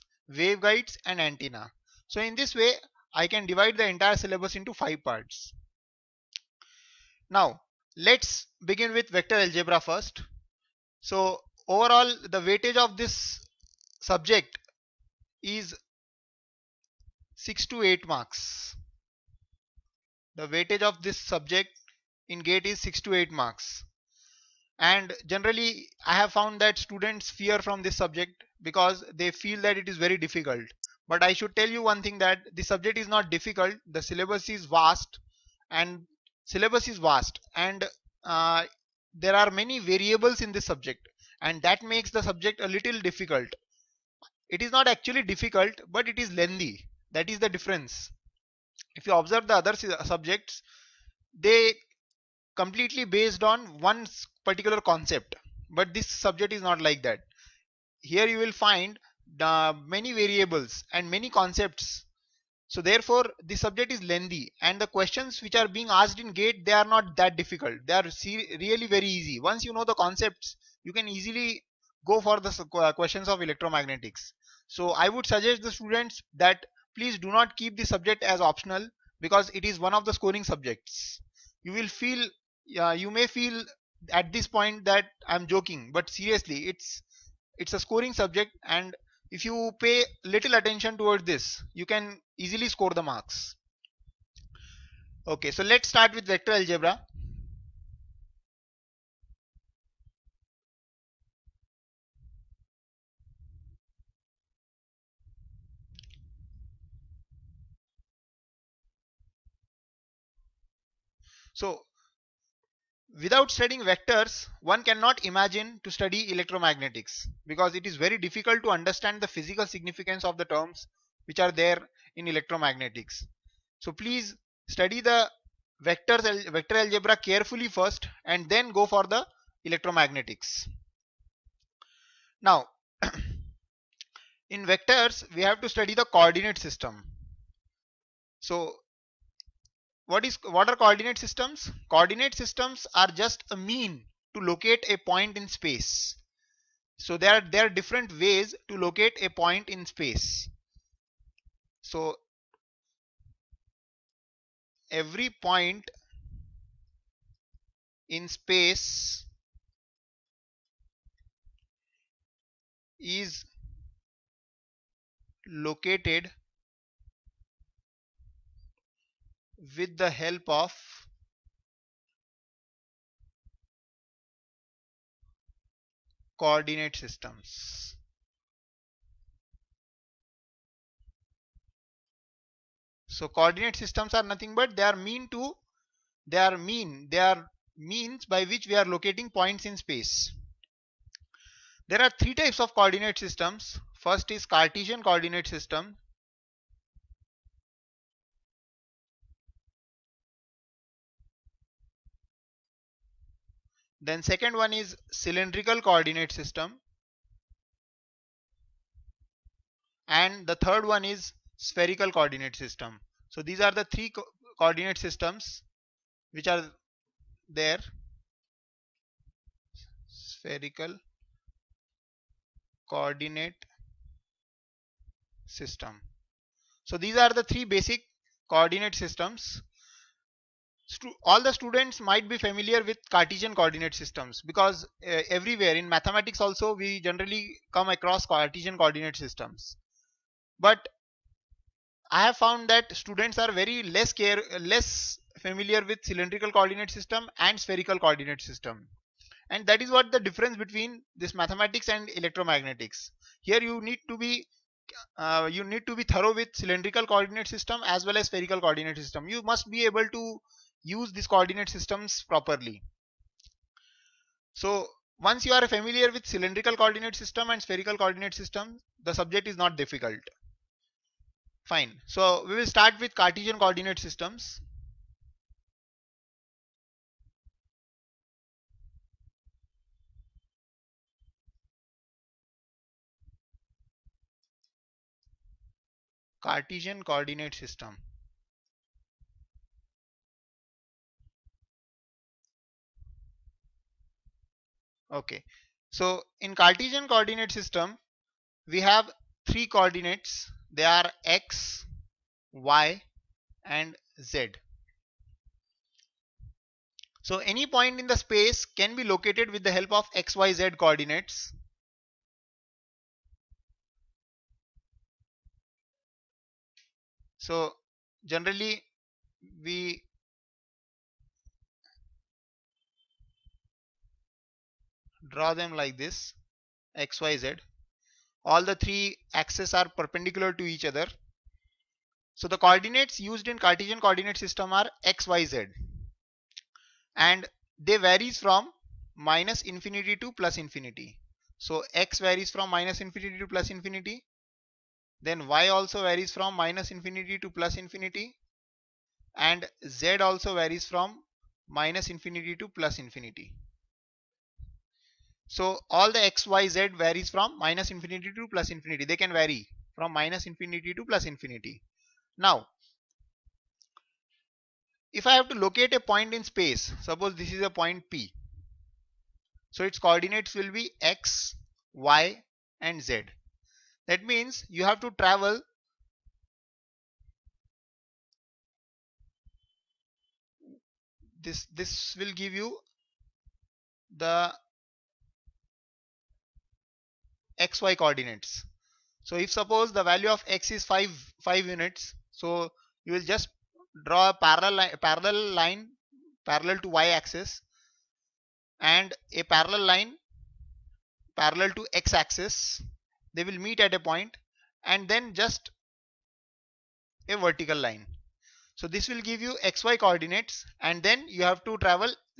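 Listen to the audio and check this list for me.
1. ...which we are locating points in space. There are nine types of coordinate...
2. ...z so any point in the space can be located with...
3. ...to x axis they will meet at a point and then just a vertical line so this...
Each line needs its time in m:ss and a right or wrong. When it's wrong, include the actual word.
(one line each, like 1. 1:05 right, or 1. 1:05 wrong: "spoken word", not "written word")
1. 3:08 wrong: "three", not "nine"
2. 5:04 right
3. 6:41 right.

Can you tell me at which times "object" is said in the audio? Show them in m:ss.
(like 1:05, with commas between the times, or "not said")
not said.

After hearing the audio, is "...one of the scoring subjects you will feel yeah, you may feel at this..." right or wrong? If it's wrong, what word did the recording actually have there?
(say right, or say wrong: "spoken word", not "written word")
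right.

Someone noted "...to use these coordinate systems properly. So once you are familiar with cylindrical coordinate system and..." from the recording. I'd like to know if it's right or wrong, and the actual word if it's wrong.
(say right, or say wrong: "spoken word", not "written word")
right.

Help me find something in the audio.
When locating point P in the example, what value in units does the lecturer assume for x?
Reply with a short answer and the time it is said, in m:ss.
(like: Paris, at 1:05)
5, at 6:31.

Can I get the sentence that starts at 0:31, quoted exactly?
But I should tell you one thing that the subject is not difficult.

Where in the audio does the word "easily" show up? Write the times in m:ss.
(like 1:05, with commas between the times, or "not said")
1:11, 1:32.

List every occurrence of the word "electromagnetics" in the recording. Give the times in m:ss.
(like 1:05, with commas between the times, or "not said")
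1:13, 1:56, 2:02, 2:09, 4:12.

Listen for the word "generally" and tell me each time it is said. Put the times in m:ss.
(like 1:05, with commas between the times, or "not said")
0:25, 3:56, 5:18.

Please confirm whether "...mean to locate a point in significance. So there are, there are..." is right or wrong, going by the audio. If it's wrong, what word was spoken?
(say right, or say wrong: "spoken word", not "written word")
wrong: "space", not "significance".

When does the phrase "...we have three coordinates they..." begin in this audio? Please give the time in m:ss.
4:58.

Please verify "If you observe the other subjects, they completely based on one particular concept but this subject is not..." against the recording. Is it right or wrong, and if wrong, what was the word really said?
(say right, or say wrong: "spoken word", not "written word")
right.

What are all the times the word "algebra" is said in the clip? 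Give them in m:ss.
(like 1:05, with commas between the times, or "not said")
0:09, 1:36, 2:06.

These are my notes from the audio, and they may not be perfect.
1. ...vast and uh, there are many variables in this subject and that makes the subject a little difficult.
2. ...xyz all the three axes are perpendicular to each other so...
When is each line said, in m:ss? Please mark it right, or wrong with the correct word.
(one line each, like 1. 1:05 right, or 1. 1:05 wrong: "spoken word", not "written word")
1. 0:36 right
2. 5:27 right.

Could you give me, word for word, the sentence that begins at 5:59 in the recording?
They can vary from minus infinity to plus infinity.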